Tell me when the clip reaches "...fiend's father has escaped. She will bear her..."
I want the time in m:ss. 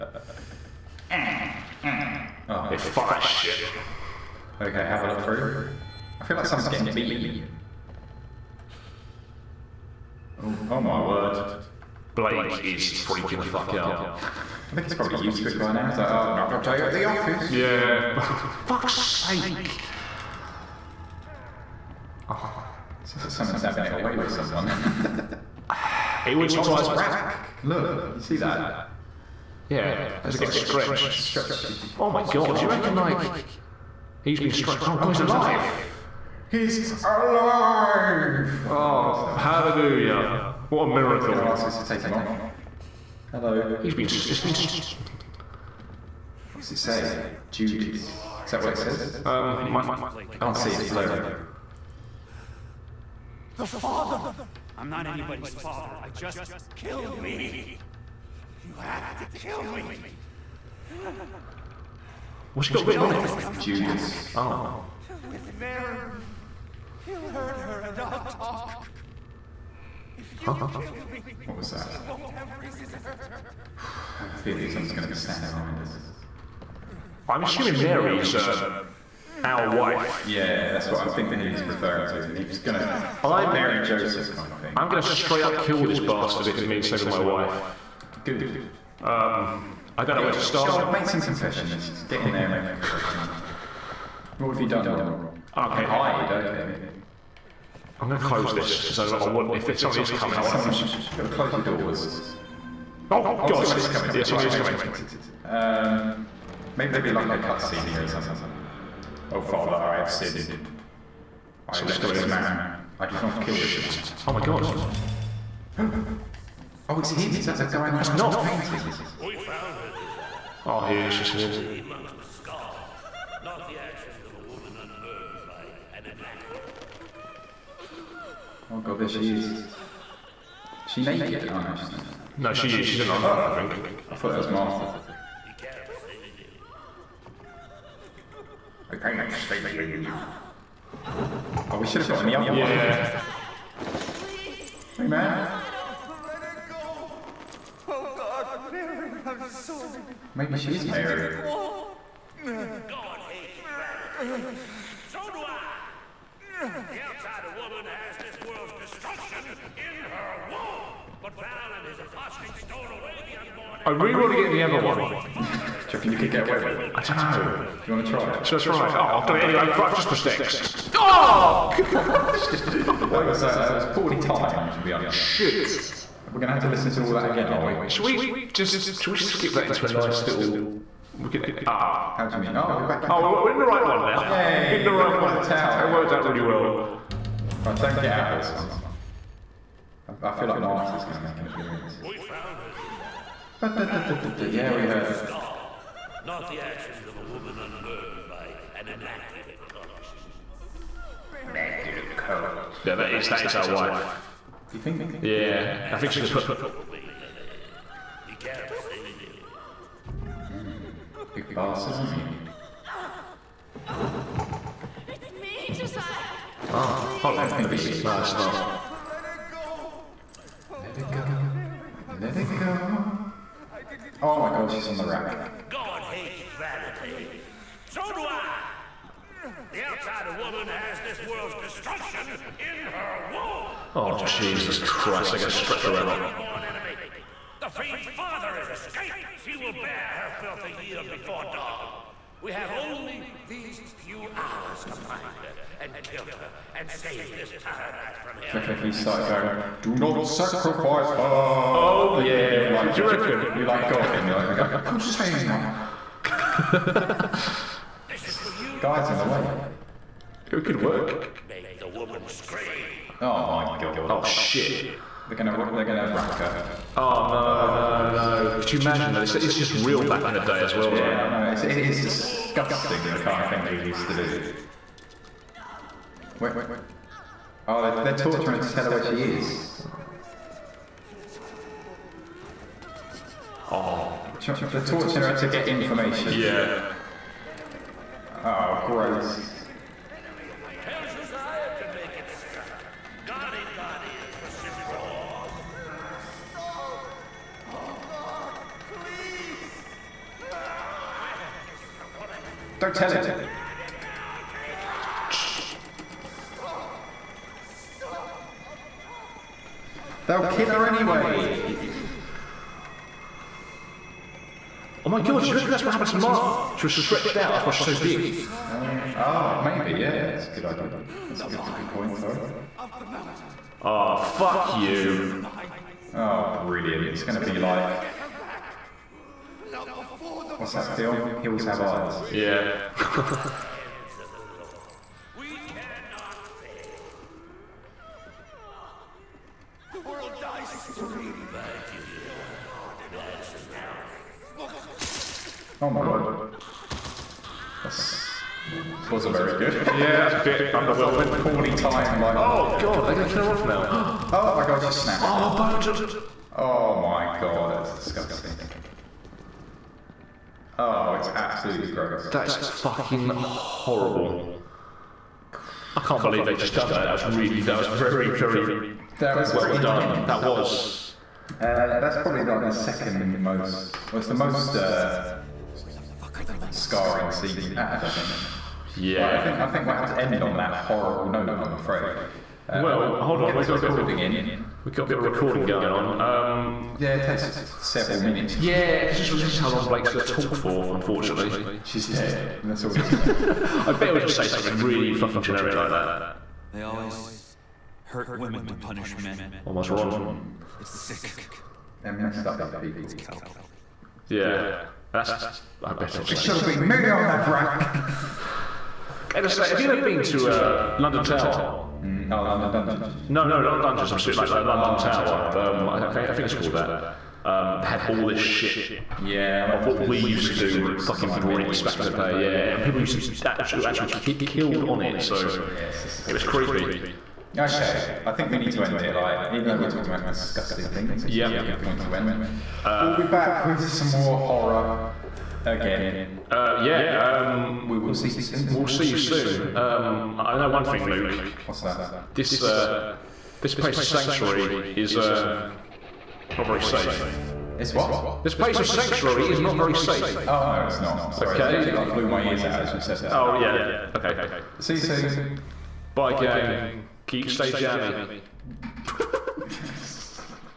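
3:57.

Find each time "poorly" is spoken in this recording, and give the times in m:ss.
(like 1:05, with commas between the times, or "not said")
2:53, 5:51.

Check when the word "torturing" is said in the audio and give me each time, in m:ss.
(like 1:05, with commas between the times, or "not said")
4:38, 4:44.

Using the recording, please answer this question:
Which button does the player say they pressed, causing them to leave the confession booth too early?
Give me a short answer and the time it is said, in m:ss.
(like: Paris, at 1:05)
X, at 2:49.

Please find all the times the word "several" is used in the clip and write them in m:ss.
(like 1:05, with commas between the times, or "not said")
6:27.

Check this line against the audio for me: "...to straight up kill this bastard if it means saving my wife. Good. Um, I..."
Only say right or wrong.
right.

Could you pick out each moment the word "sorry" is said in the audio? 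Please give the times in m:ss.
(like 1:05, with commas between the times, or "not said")
2:29, 5:22, 7:31.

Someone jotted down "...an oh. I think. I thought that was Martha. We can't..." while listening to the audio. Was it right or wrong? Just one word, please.
right.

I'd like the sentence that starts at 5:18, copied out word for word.
Um, oh, maybe, yeah, that's a good idea.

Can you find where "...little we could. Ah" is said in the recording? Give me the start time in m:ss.
3:00.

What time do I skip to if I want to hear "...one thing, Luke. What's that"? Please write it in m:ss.
7:20.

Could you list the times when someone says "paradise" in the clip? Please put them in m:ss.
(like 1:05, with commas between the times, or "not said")
4:07.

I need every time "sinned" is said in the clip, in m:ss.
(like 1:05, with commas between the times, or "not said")
1:50.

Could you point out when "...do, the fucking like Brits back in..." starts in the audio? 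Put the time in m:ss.
7:00.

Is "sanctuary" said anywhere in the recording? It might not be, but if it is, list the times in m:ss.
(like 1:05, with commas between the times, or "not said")
7:24, 7:28.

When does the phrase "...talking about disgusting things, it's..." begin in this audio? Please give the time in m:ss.
7:09.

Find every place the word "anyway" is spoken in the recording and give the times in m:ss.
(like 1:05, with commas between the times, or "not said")
2:49, 5:10.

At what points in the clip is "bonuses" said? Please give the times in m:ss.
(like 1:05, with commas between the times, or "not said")
not said.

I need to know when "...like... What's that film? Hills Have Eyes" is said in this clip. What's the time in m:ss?
5:27.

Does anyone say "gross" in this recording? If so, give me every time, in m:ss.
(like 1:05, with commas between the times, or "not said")
4:48, 6:01.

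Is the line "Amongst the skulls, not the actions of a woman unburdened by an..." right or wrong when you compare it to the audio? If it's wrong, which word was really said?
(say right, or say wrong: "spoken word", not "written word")
right.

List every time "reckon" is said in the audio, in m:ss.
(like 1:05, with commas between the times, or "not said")
0:32, 4:08, 4:13, 5:15.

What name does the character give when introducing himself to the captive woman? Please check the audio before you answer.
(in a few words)
Josiah.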